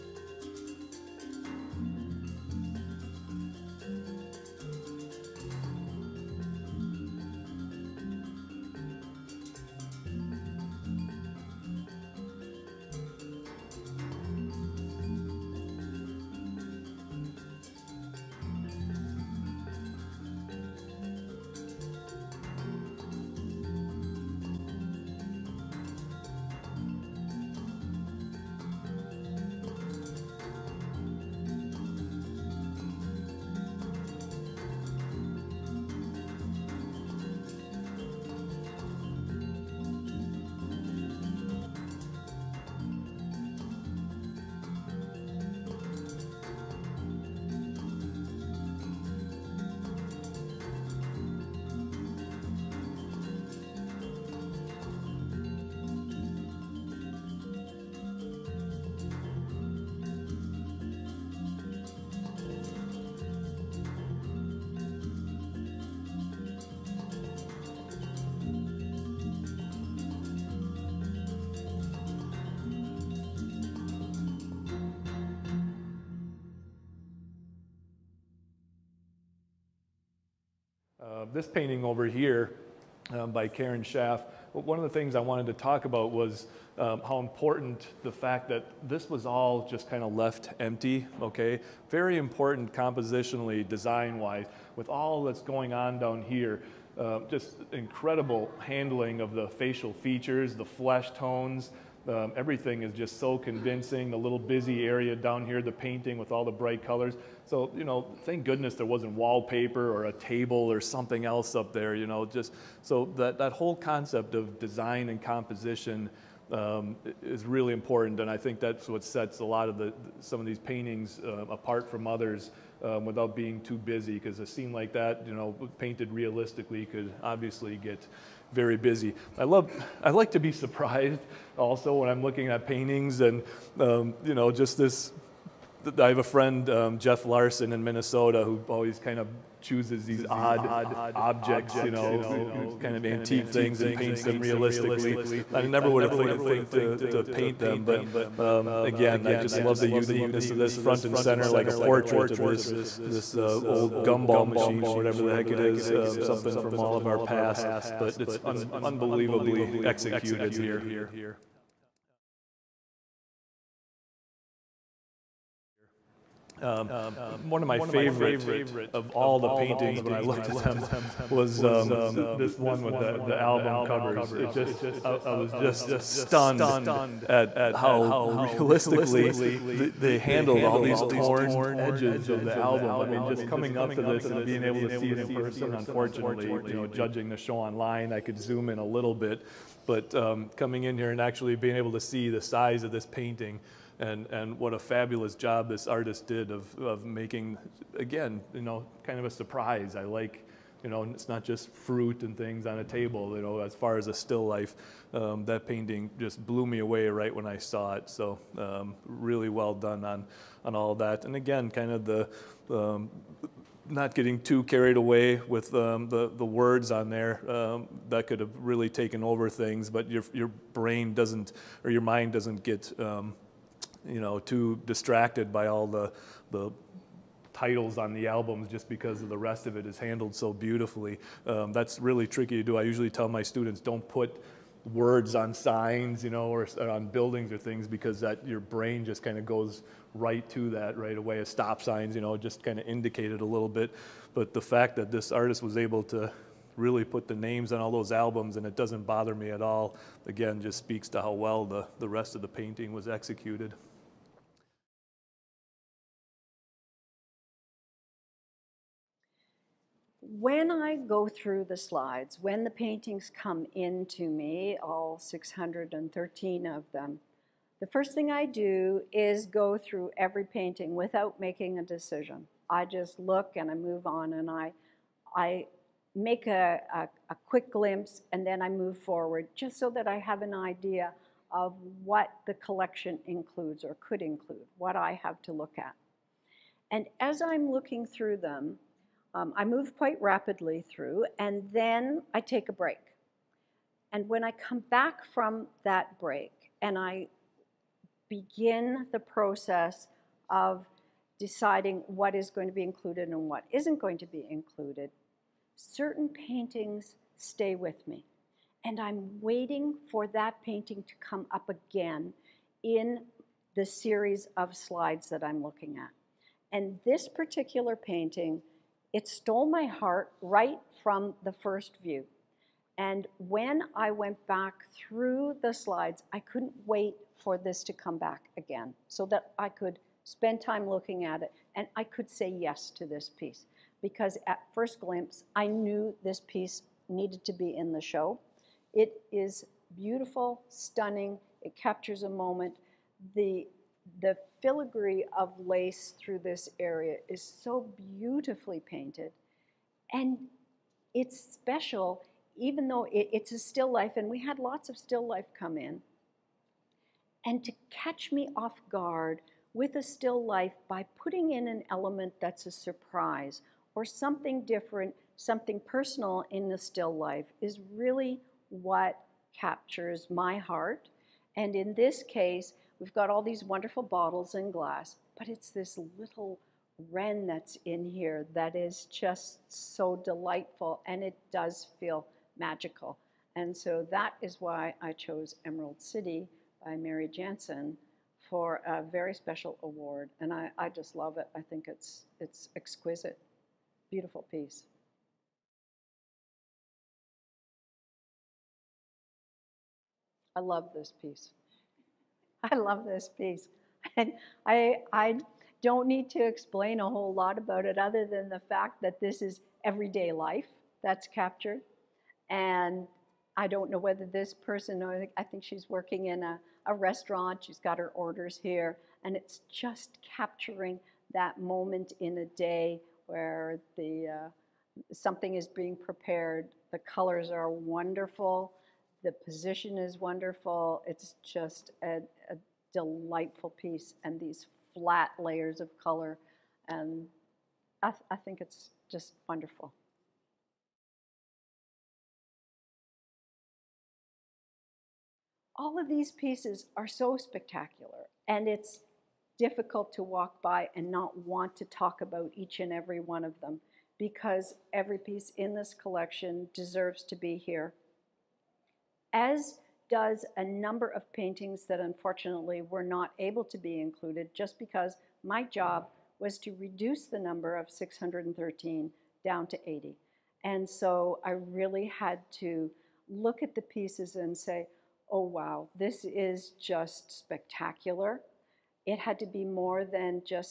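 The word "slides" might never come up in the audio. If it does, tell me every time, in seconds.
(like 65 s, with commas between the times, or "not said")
261 s, 314 s, 325 s.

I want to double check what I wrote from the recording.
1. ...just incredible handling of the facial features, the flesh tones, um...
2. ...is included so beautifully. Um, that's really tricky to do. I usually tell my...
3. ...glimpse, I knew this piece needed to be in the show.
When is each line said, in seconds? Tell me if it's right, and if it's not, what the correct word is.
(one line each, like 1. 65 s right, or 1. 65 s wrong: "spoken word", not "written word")
1. 97 s right
2. 229 s wrong: "handled", not "included"
3. 334 s right.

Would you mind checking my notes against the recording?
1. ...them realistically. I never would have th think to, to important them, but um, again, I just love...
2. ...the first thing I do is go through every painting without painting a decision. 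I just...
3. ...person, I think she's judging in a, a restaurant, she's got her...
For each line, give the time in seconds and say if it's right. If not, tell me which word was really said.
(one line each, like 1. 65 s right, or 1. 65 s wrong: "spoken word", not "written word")
1. 144 s wrong: "paint", not "important"
2. 267 s wrong: "making", not "painting"
3. 414 s wrong: "working", not "judging".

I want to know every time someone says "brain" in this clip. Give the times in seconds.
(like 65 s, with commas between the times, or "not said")
220 s, 238 s.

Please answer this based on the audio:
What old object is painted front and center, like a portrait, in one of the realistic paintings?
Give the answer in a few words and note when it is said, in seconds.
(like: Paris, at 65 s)
gumball machine, at 154 s.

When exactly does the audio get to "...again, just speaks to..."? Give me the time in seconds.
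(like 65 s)
250 s.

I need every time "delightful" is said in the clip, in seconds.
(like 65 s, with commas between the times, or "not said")
380 s, 432 s.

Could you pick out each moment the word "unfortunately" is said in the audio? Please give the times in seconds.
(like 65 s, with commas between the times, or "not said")
185 s, 461 s.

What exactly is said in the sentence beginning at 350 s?
And it's special, even though it, it's a still life, and we had lots of still life come in.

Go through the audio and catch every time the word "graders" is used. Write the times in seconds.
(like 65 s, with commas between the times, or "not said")
not said.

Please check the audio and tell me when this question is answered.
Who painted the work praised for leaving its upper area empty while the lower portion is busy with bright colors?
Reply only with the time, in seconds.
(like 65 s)
83 s.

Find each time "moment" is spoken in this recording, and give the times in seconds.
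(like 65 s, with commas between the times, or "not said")
342 s, 421 s.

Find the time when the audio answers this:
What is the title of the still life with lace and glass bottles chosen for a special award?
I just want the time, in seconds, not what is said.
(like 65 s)
385 s.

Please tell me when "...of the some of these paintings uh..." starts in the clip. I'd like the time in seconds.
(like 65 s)
119 s.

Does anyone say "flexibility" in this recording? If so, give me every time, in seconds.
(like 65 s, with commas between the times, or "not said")
not said.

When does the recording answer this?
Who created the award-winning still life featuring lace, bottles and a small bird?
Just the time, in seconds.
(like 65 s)
386 s.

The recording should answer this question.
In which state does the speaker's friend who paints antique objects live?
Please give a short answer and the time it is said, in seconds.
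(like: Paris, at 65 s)
Minnesota, at 137 s.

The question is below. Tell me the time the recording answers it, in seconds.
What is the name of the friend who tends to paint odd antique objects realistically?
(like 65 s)
136 s.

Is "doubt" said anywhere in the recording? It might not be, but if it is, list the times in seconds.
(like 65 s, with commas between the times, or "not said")
not said.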